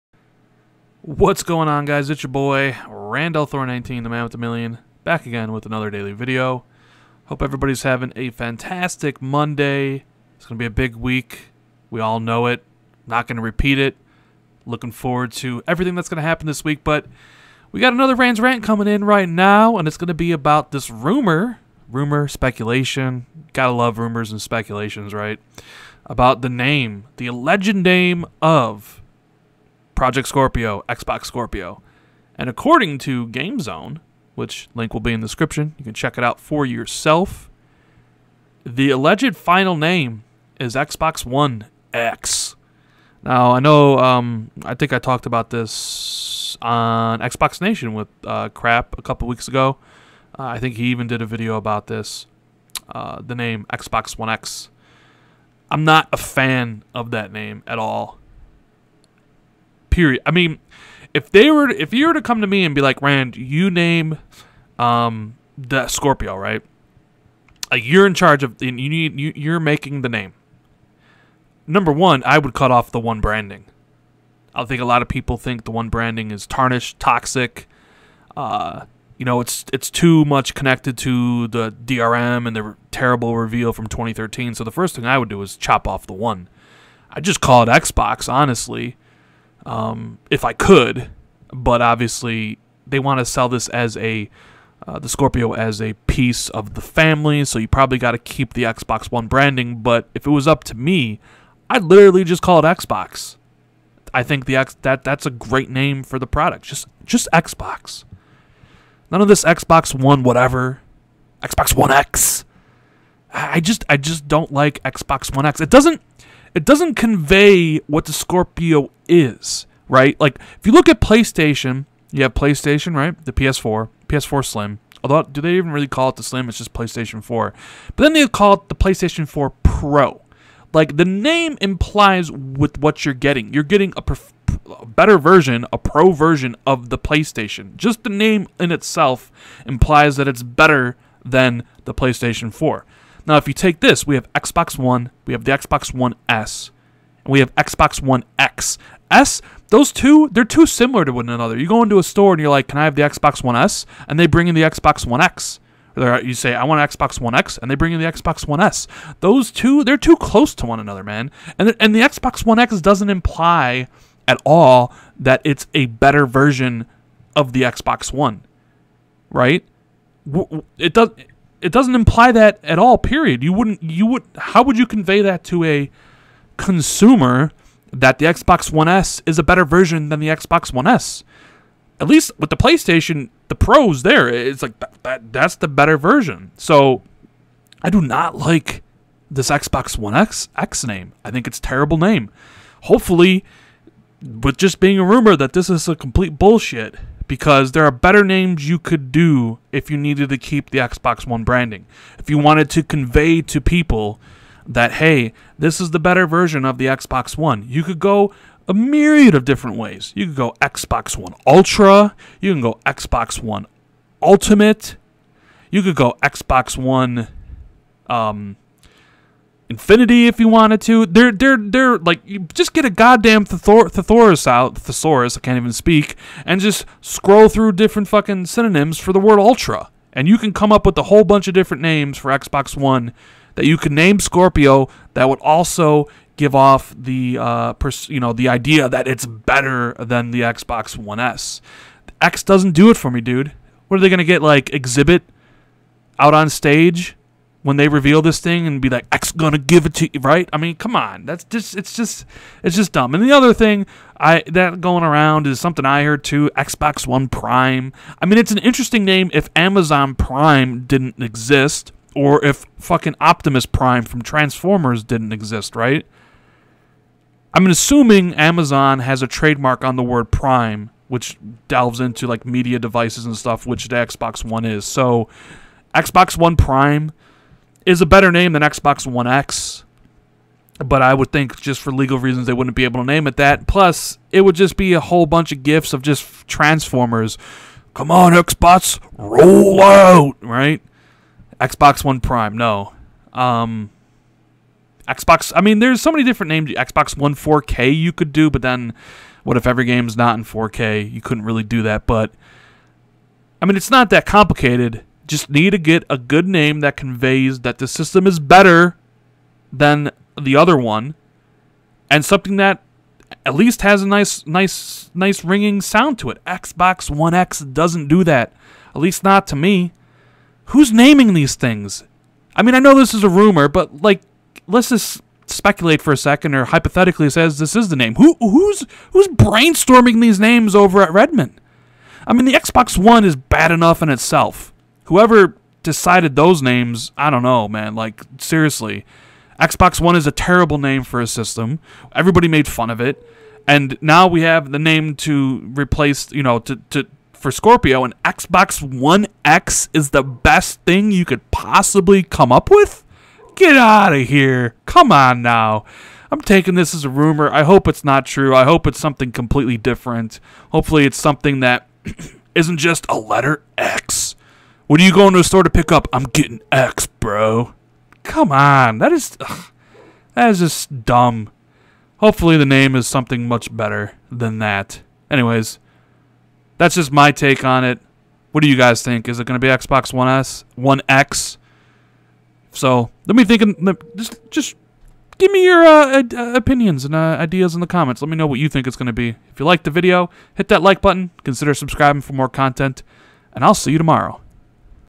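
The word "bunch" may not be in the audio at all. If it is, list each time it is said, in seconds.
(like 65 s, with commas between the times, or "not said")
231 s, 285 s.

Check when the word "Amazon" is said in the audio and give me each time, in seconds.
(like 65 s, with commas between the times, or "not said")
259 s, 268 s.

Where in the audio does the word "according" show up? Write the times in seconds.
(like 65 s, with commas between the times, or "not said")
32 s.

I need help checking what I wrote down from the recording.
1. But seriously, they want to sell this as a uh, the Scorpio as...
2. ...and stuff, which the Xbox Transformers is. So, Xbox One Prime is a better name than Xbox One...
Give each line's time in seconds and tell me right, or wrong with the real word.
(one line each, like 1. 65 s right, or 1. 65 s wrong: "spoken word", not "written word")
1. 91 s wrong: "obviously", not "seriously"
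2. 273 s wrong: "One", not "Transformers".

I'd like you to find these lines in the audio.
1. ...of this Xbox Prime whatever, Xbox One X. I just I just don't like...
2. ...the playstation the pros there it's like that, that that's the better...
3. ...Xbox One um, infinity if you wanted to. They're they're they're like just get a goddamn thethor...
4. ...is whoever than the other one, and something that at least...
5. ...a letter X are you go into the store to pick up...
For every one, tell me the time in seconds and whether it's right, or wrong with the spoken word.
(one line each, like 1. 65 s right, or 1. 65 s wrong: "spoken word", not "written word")
1. 109 s wrong: "One", not "Prime"
2. 182 s right
3. 216 s right
4. 308 s wrong: "better", not "whoever"
5. 363 s right.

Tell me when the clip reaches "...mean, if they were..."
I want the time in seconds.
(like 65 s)
60 s.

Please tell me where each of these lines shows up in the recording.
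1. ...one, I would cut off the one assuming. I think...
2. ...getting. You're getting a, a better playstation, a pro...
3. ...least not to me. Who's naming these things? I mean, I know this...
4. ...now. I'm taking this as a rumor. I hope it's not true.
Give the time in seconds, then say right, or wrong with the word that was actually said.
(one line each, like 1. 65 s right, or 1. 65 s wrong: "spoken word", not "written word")
1. 71 s wrong: "branding", not "assuming"
2. 133 s wrong: "version", not "playstation"
3. 319 s right
4. 355 s right.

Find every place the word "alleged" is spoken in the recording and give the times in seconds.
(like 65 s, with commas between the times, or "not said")
27 s, 38 s.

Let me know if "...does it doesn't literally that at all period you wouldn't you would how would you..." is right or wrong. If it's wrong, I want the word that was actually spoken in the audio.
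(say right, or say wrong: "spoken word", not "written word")
wrong: "imply", not "literally".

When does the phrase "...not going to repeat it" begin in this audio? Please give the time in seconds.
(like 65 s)
13 s.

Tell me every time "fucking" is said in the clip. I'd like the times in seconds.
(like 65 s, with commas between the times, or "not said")
228 s, 262 s.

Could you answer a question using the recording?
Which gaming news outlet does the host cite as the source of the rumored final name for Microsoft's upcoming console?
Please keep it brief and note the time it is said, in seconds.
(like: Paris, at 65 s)
GameZone, at 33 s.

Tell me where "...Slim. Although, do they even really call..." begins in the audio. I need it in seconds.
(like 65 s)
124 s.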